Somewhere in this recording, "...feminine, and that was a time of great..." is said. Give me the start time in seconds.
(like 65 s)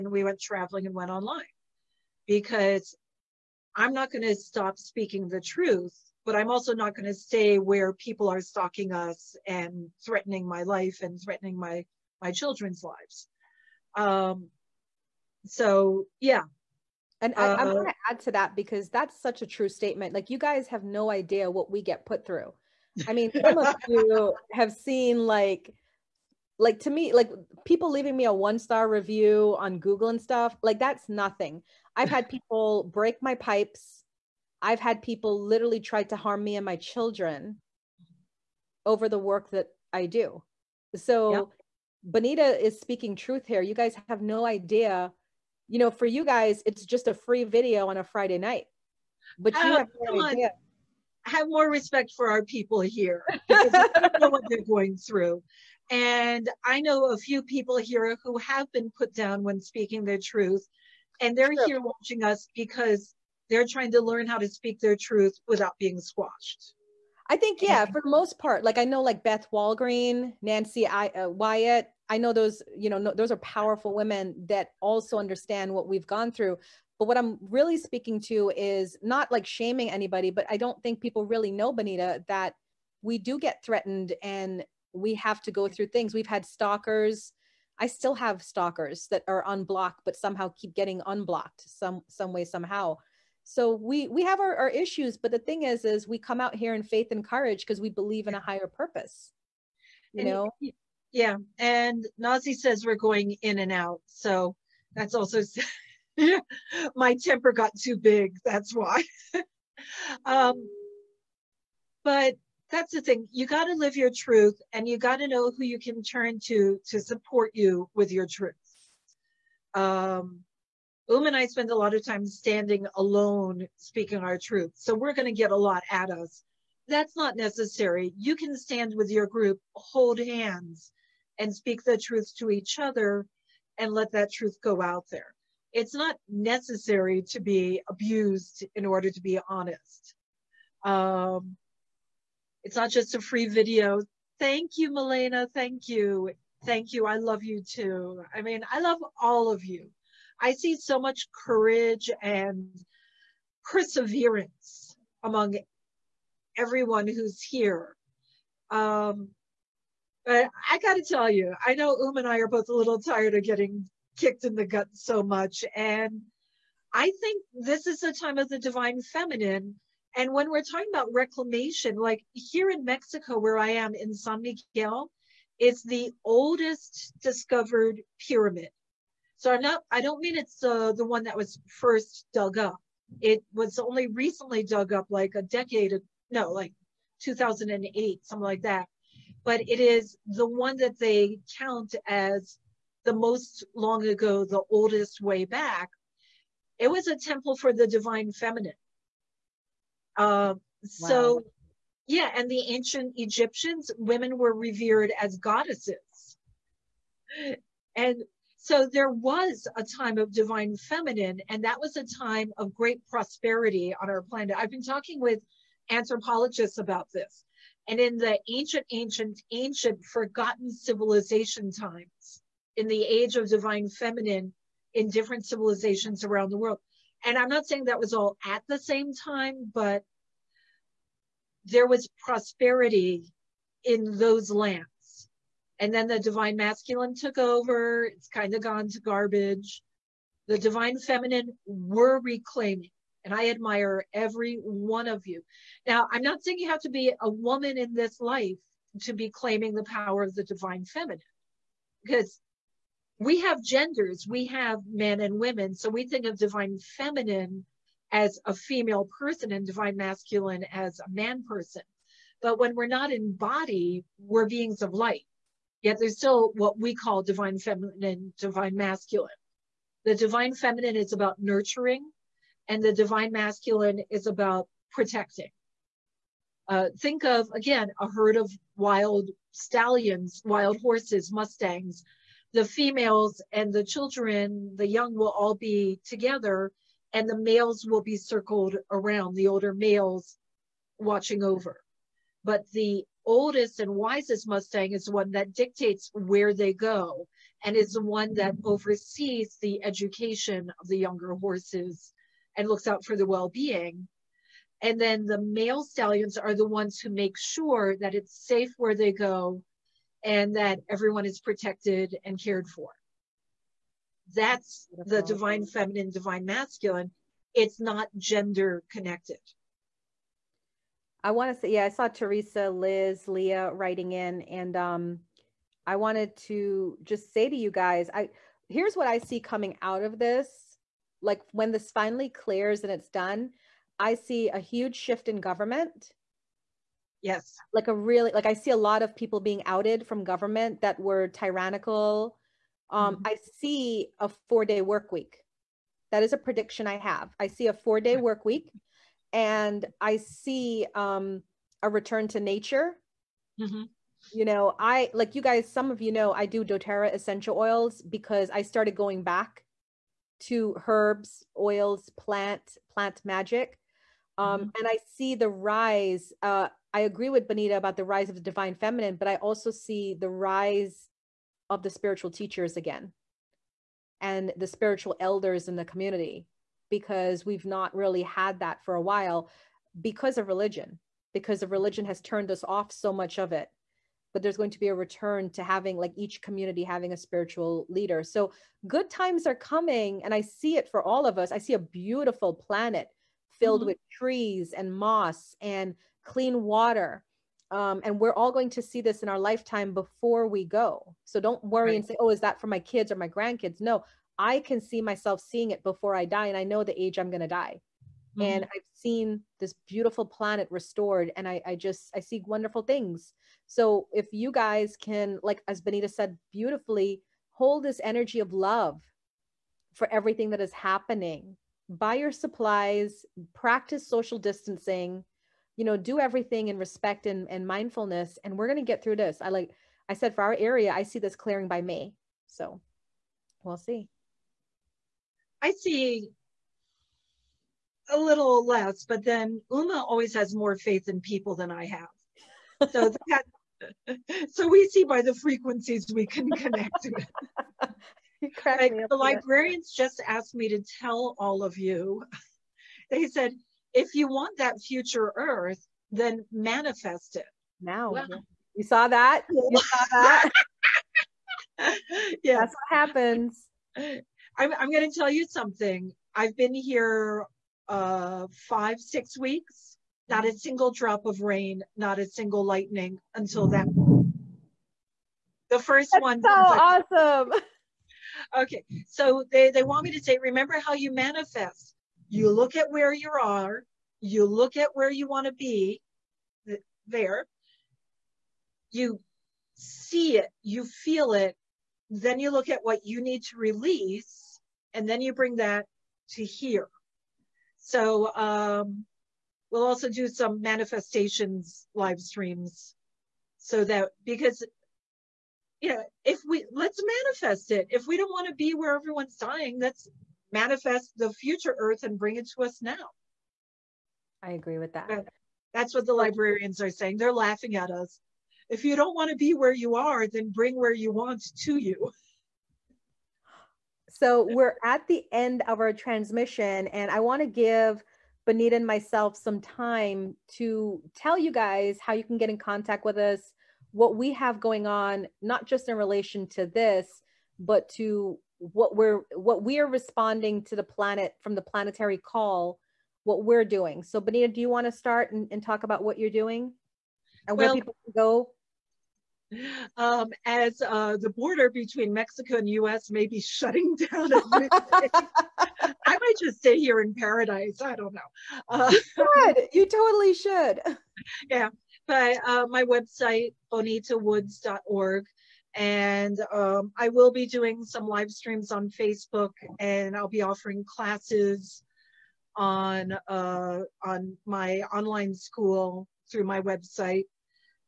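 210 s.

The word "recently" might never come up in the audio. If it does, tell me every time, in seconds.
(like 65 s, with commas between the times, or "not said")
184 s.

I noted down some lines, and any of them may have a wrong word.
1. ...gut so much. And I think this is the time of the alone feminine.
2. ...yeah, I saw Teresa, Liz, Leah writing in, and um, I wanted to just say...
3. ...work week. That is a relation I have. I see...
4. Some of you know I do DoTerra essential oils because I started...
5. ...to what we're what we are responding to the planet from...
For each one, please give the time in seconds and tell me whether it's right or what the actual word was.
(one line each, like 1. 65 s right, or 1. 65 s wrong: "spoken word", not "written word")
1. 164 s wrong: "divine", not "alone"
2. 321 s right
3. 344 s wrong: "prediction", not "relation"
4. 355 s right
5. 537 s right.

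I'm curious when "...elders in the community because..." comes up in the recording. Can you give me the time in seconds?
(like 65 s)
375 s.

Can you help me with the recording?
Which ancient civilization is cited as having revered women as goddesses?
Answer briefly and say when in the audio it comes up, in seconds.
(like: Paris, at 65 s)
Egyptians, at 203 s.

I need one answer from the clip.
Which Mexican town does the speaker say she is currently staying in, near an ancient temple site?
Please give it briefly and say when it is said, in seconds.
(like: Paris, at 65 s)
San Miguel, at 174 s.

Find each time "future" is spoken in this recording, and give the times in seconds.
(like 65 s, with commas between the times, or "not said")
454 s, 511 s.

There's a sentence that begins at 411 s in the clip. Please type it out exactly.
And I, I just, I see wonderful things.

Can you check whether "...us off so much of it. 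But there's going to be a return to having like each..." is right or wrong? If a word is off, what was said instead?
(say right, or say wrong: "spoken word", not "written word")
right.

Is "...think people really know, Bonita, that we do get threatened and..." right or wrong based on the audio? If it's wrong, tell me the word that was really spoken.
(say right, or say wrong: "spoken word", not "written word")
right.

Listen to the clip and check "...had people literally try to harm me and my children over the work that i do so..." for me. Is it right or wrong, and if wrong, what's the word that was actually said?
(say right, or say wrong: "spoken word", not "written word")
right.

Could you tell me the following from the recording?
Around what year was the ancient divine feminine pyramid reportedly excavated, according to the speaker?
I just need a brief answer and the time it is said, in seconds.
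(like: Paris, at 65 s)
2008, at 187 s.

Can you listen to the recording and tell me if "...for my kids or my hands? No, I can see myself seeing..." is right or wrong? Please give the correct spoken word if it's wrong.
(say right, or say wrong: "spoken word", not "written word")
wrong: "grandkids", not "hands".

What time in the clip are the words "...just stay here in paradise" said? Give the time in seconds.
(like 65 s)
556 s.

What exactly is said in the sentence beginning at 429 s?
I like, I said for our area, I see this clearing by May.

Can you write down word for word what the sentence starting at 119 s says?
Um, Um and I spend a lot of time standing alone speaking our truth.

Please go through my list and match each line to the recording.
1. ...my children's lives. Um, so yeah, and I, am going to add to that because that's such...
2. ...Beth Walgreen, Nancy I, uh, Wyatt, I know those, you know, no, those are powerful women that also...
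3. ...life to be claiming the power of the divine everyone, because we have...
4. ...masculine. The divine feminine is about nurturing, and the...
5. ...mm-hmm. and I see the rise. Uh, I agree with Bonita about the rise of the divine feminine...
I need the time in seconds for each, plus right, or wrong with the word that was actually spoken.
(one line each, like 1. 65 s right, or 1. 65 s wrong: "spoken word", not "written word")
1. 12 s right
2. 69 s right
3. 248 s wrong: "feminine", not "everyone"
4. 268 s right
5. 364 s right.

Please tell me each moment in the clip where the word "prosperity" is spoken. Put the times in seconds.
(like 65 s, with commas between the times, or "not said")
213 s, 232 s.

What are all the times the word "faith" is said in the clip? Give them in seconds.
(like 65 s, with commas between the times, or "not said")
96 s, 440 s.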